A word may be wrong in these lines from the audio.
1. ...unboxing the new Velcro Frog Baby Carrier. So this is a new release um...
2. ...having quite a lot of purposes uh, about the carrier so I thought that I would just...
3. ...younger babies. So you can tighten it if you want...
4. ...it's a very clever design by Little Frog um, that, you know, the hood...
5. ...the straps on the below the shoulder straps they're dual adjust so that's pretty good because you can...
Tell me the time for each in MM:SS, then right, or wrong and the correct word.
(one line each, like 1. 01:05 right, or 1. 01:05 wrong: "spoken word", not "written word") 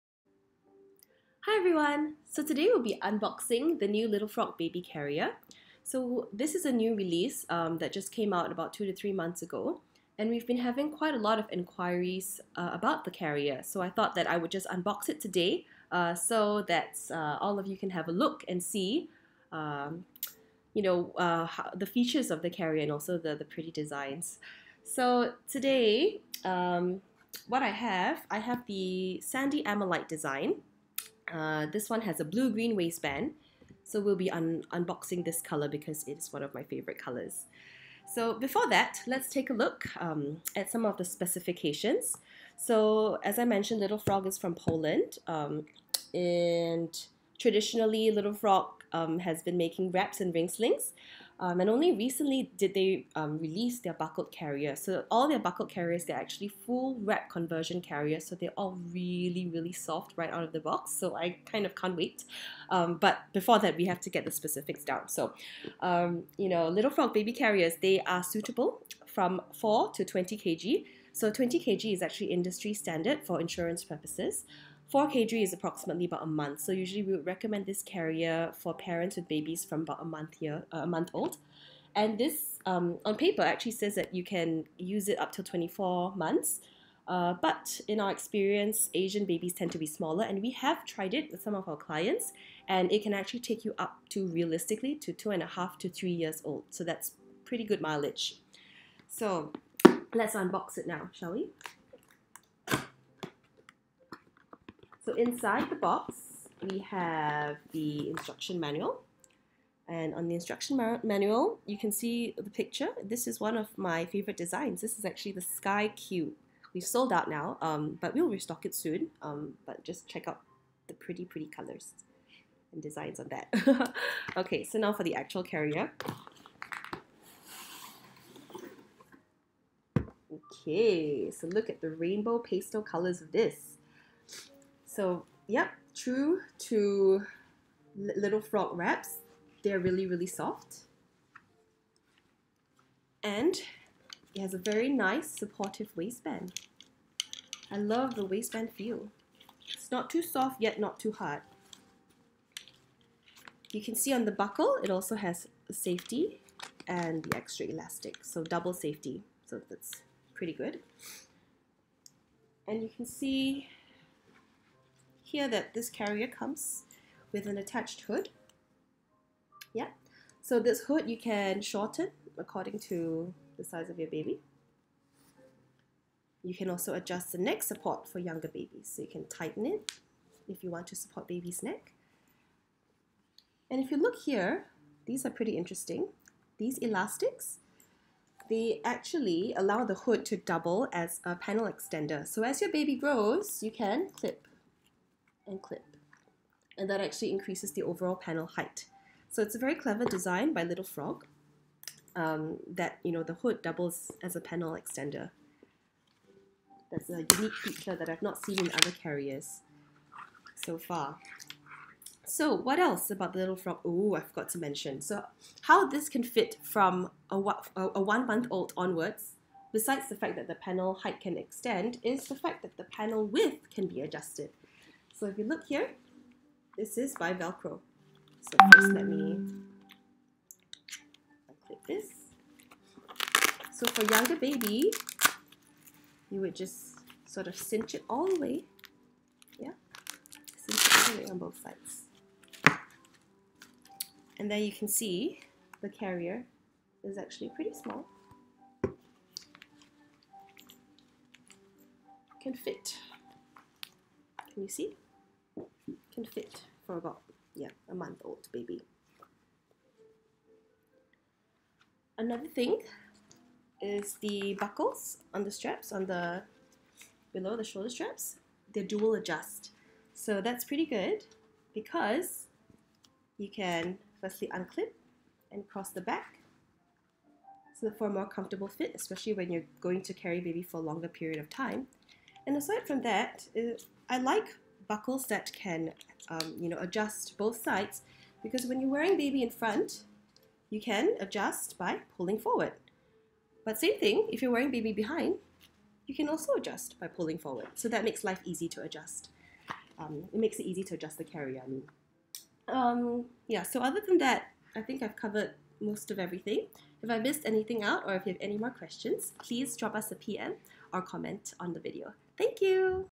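1. 00:03 wrong: "Little", not "Velcro"
2. 00:10 wrong: "inquiries", not "purposes"
3. 02:58 right
4. 03:19 right
5. 04:25 right.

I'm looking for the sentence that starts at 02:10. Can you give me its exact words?
Okay, so look at the rainbow pastel colors of this.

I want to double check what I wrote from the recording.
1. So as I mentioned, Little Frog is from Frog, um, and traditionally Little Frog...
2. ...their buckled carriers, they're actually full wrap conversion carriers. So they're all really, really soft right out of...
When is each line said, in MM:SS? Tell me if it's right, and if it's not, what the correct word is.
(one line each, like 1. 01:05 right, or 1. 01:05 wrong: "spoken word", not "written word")
1. 00:42 wrong: "Poland", not "Frog"
2. 00:55 right.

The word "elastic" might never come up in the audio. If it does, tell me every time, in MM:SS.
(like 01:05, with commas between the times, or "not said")
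02:37, 03:06.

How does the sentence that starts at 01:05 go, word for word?
So, um, you know, Little Frog baby carriers, they are suitable from 4 to 20 kg.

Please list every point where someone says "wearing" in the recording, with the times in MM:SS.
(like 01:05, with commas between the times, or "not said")
04:48, 04:54.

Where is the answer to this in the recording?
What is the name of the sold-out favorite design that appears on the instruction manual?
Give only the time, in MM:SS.
01:55.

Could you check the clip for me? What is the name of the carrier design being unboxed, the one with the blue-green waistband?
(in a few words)
Sandy Amalite.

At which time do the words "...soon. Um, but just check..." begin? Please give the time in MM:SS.
01:58.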